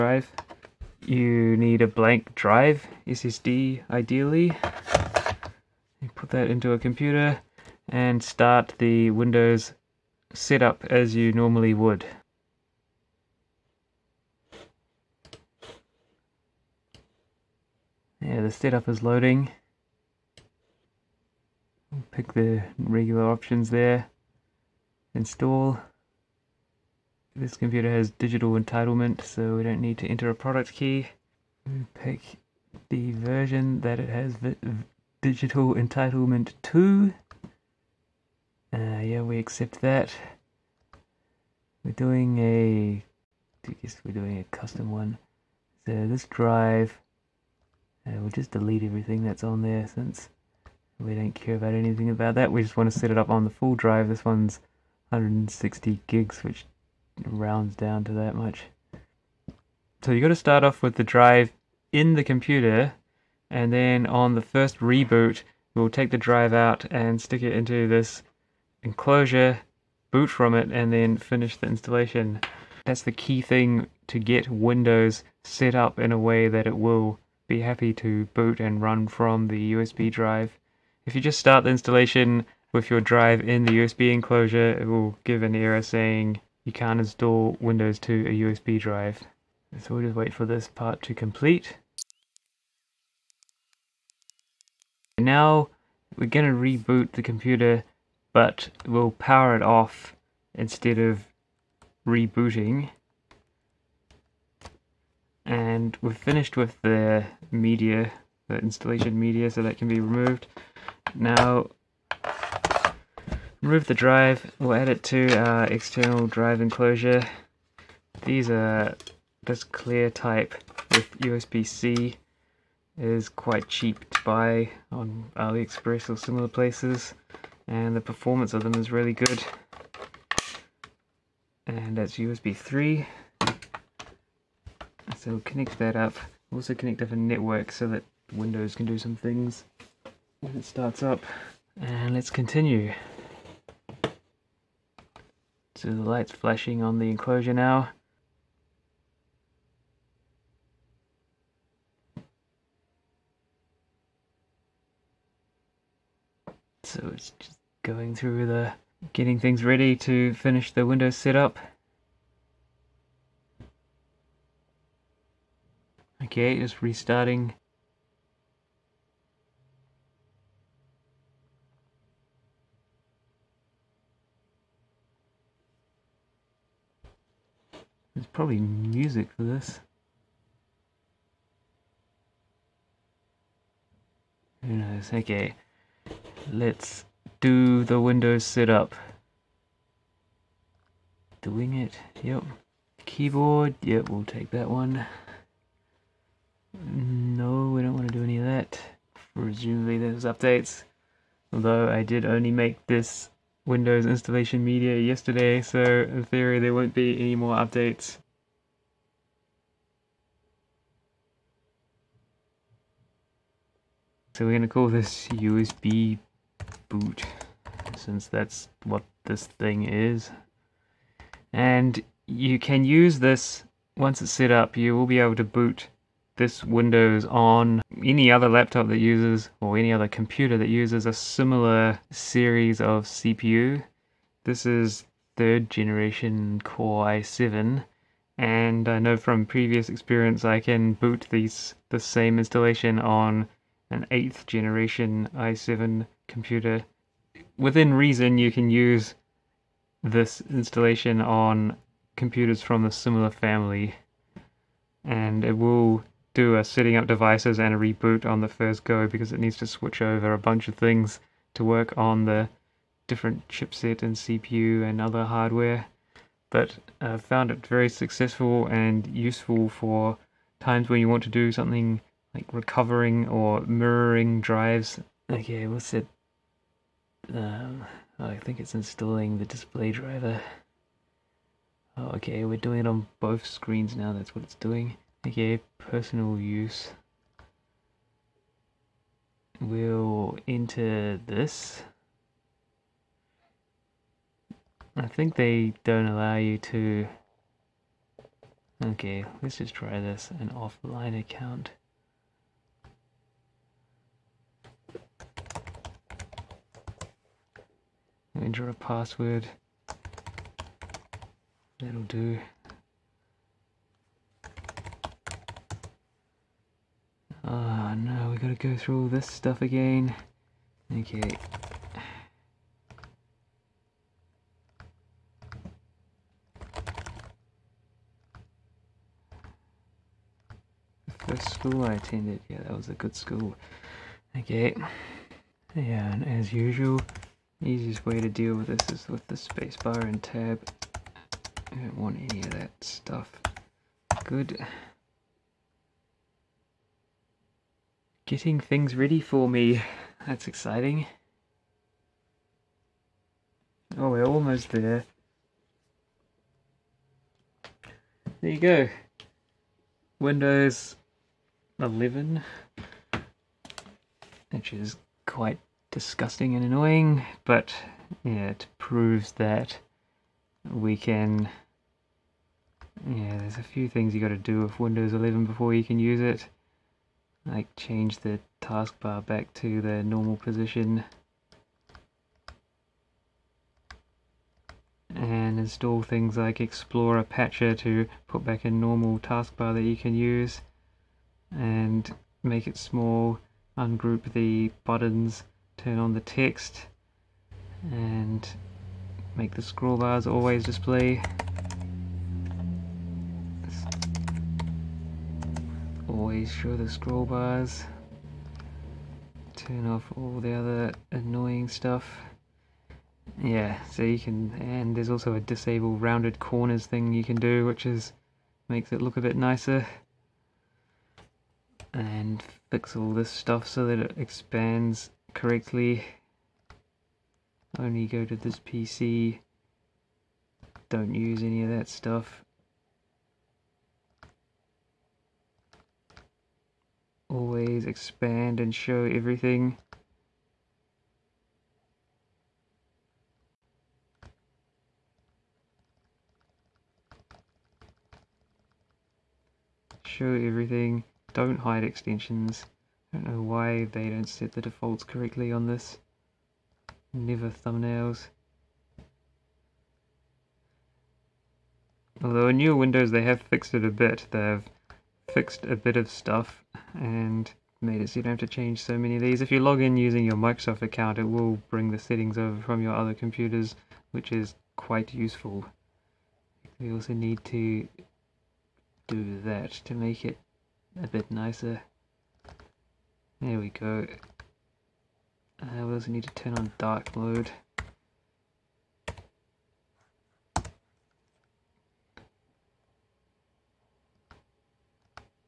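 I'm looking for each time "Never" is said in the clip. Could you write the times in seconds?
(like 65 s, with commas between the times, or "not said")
457 s.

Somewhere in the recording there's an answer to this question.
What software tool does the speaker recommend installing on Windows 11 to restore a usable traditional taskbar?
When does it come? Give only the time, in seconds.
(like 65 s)
386 s.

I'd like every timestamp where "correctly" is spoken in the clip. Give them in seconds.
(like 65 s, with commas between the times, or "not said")
425 s, 455 s.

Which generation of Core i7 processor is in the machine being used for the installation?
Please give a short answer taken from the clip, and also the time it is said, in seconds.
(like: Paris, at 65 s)
Third generation, at 235 s.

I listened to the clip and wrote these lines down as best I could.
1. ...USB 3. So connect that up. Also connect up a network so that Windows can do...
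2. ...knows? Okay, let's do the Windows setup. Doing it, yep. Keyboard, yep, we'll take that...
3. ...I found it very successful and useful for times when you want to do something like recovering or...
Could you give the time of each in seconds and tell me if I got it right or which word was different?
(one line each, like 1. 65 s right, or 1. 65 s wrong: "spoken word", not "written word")
1. 132 s right
2. 184 s right
3. 267 s right.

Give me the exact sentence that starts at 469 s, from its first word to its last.
If you log in using your Microsoft account, it will bring the settings over from your other computers, which is quite useful.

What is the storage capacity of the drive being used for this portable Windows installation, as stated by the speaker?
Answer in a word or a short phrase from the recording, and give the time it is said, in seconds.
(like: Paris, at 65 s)
160 GB, at 55 s.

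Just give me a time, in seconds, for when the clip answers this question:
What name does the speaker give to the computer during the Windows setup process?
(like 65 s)
215 s.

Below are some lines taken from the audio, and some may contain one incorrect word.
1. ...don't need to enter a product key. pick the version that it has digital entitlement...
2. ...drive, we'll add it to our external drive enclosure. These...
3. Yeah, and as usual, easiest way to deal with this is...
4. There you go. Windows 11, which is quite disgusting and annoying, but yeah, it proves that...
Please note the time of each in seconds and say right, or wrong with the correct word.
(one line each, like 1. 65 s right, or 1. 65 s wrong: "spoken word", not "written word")
1. 29 s right
2. 113 s right
3. 335 s right
4. 358 s right.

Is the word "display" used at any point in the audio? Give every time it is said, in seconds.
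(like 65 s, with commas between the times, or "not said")
279 s, 400 s.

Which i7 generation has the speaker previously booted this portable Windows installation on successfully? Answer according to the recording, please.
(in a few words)
8th generation.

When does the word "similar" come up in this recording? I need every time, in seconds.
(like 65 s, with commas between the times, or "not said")
126 s, 231 s, 252 s.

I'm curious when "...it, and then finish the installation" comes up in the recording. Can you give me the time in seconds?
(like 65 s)
70 s.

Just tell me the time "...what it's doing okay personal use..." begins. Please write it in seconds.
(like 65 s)
284 s.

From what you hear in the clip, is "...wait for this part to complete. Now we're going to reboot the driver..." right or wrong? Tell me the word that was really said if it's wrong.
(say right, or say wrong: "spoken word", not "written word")
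wrong: "computer", not "driver".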